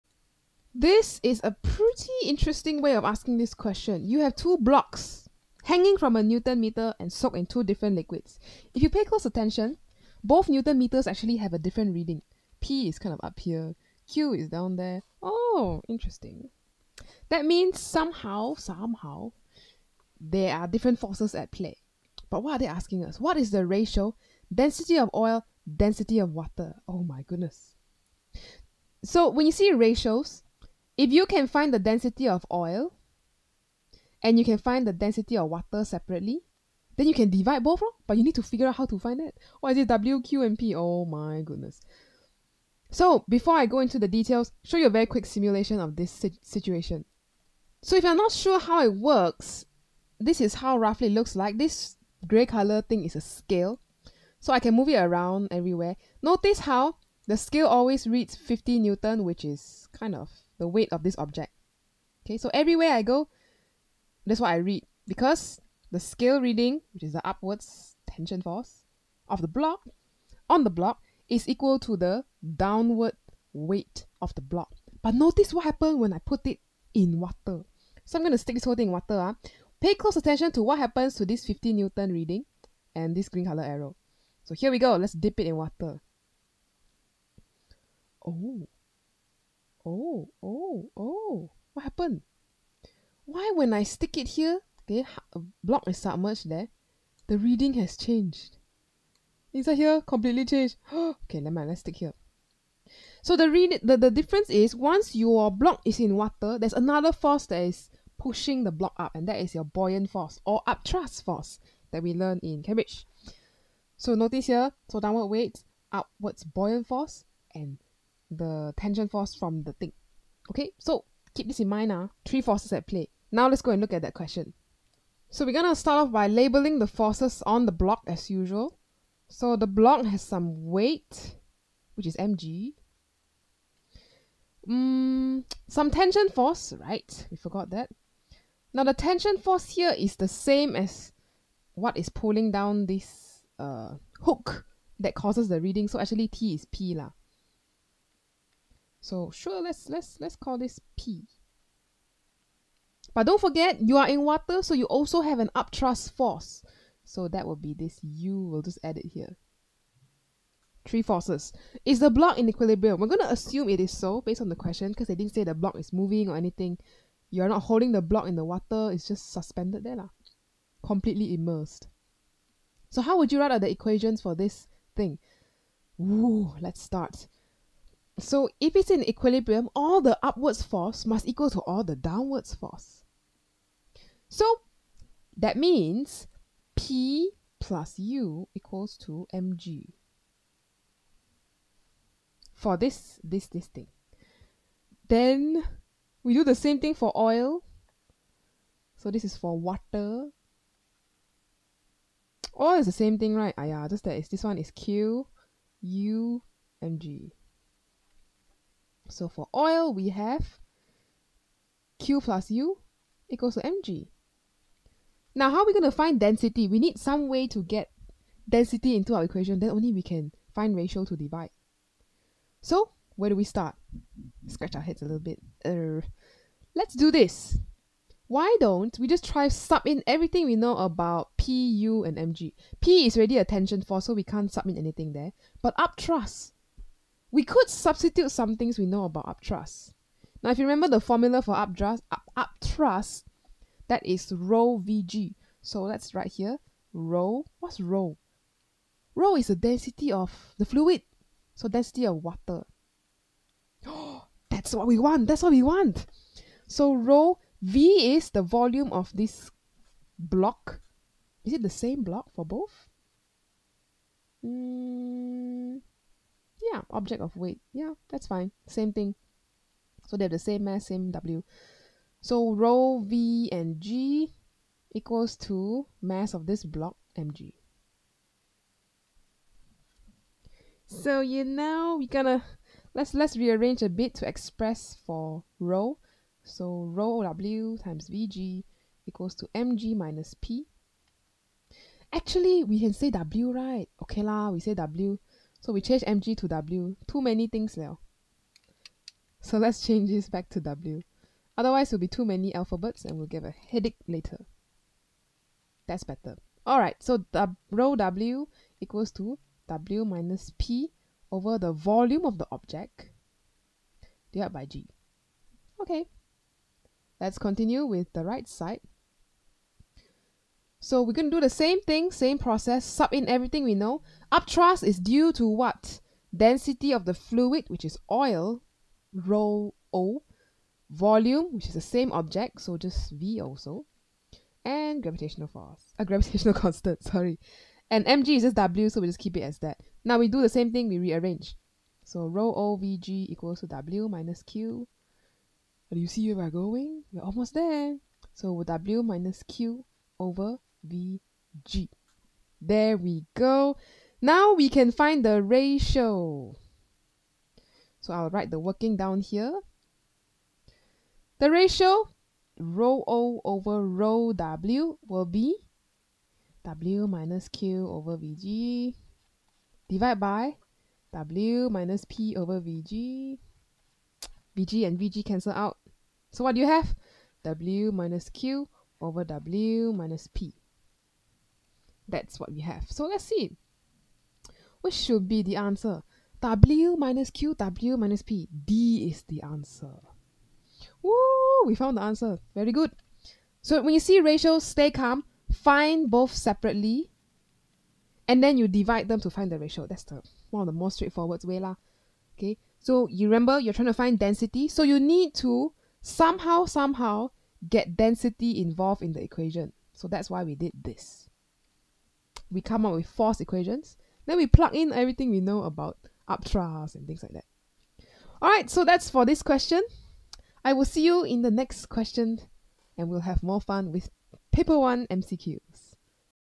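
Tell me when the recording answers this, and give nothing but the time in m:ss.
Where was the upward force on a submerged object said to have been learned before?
1:52.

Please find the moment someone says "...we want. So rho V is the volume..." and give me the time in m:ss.
4:15.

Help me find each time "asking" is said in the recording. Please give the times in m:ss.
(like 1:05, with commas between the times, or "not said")
0:03, 0:22.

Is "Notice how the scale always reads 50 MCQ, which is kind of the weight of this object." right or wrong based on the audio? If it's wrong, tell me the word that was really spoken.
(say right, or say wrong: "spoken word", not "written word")
wrong: "Newton", not "MCQ".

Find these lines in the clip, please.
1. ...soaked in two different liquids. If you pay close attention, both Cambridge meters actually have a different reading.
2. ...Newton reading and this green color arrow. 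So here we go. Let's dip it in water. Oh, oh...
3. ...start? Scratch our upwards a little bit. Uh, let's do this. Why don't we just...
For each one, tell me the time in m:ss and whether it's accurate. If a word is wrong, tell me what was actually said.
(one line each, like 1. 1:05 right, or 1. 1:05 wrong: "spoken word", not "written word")
1. 0:07 wrong: "Newton", not "Cambridge"
2. 1:21 right
3. 3:43 wrong: "heads", not "upwards".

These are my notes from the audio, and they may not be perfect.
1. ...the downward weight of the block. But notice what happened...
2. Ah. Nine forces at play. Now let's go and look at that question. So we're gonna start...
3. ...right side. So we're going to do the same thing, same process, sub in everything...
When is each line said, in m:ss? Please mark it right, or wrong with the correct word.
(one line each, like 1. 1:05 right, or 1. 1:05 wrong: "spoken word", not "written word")
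1. 1:11 right
2. 2:02 wrong: "Three", not "Nine"
3. 5:18 right.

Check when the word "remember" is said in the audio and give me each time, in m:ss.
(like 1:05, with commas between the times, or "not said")
4:00, 6:43.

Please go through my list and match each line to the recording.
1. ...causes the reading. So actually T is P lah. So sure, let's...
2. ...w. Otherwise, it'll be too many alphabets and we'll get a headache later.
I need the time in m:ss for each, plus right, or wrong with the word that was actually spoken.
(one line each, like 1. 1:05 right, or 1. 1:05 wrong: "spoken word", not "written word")
1. 2:25 right
2. 5:00 right.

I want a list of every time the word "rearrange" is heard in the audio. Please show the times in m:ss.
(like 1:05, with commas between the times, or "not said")
4:43, 5:40.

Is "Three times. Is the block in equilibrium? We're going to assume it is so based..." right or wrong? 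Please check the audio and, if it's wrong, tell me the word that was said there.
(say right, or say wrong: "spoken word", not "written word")
wrong: "forces", not "times".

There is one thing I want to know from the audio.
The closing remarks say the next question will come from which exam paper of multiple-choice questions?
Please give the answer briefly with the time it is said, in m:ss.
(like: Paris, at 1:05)
Paper 1, at 7:04.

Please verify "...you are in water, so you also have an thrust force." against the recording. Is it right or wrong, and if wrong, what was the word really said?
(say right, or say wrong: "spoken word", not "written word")
wrong: "upthrust", not "thrust".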